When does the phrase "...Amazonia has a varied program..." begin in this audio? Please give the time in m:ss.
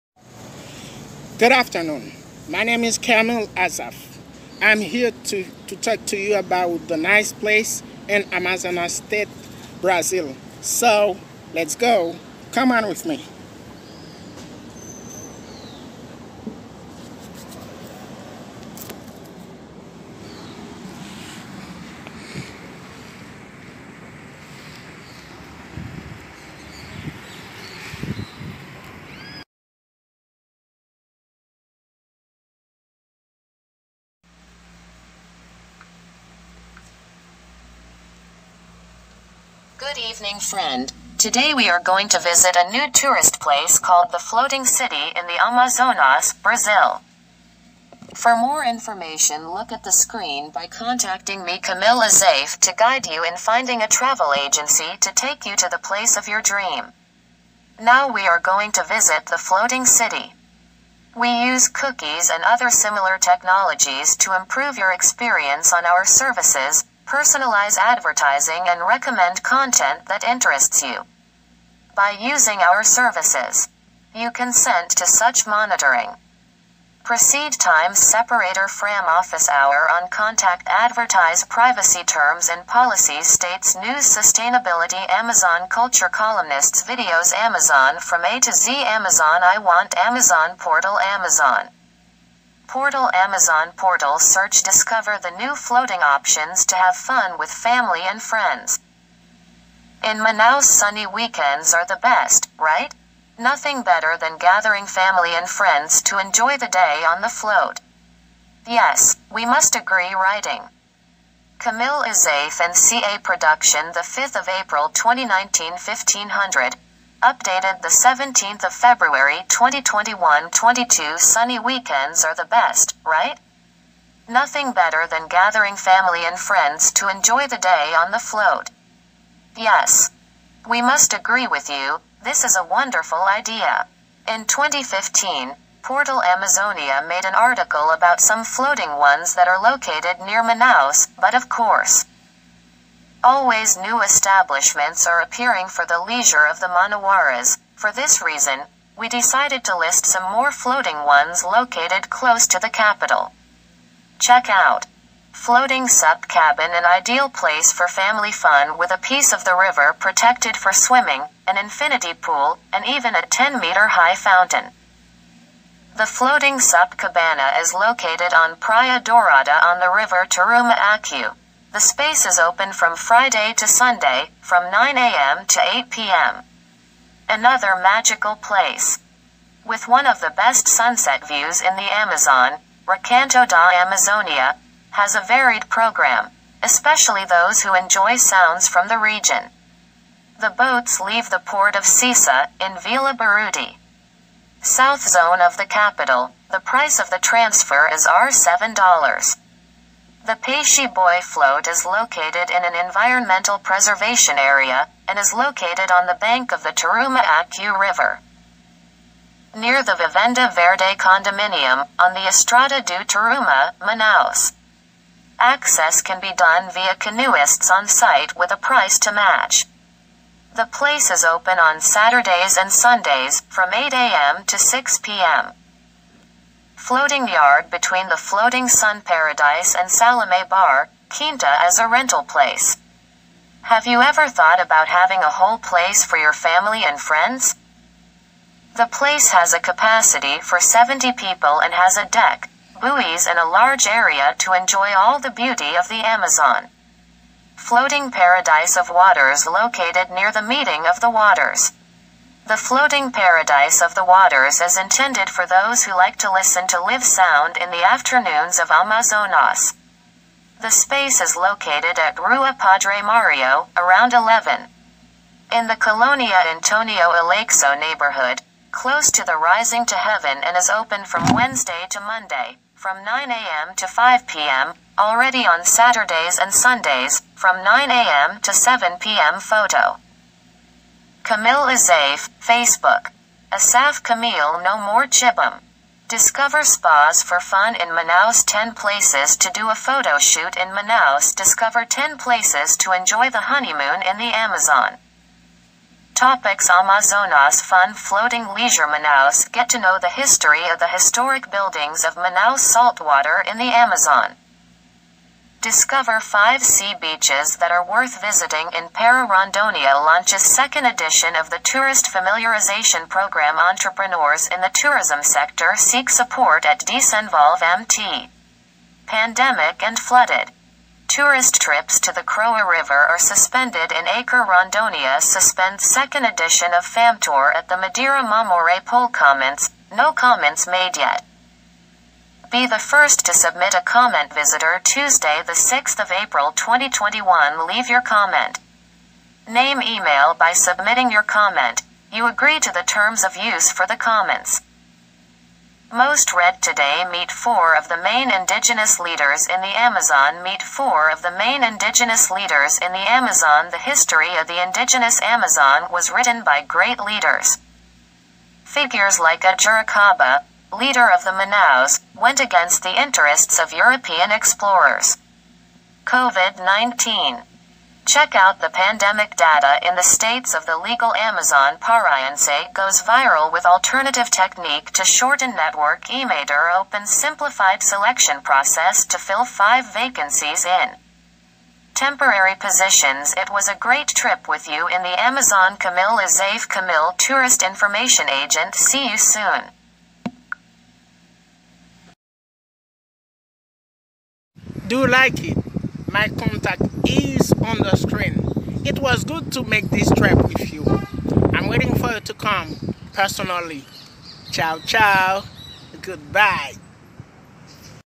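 3:03.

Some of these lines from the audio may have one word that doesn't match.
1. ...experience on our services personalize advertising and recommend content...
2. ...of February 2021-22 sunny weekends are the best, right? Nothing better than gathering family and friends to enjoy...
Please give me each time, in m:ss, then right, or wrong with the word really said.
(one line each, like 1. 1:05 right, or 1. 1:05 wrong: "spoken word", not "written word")
1. 1:04 right
2. 1:58 right.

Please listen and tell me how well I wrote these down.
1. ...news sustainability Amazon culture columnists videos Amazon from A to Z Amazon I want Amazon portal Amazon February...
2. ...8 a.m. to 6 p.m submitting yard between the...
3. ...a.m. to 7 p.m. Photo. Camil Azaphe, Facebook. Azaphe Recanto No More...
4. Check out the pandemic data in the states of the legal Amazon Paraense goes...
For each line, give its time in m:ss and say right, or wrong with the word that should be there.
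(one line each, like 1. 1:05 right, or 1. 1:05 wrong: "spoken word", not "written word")
1. 1:23 wrong: "Portal", not "February"
2. 3:43 wrong: "floating", not "submitting"
3. 4:37 wrong: "Camil", not "Recanto"
4. 6:08 right.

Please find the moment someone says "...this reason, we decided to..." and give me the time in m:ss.
2:27.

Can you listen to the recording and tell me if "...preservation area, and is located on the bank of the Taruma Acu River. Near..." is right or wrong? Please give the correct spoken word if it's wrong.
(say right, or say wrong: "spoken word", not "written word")
right.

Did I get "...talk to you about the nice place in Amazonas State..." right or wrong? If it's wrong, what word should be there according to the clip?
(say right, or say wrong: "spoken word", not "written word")
right.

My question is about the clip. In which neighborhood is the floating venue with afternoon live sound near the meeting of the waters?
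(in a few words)
Colonia Antonio Aleixo.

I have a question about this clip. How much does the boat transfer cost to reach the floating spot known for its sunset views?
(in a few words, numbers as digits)
R$7.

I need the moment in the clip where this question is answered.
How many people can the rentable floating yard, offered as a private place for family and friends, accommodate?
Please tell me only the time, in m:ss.
4:00.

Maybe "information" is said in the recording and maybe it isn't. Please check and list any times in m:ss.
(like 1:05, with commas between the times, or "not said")
0:48, 6:27.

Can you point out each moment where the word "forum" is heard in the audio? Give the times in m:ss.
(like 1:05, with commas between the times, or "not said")
not said.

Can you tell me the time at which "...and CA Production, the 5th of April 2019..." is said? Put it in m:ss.
1:52.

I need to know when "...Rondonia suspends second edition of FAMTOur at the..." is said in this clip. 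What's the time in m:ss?
5:24.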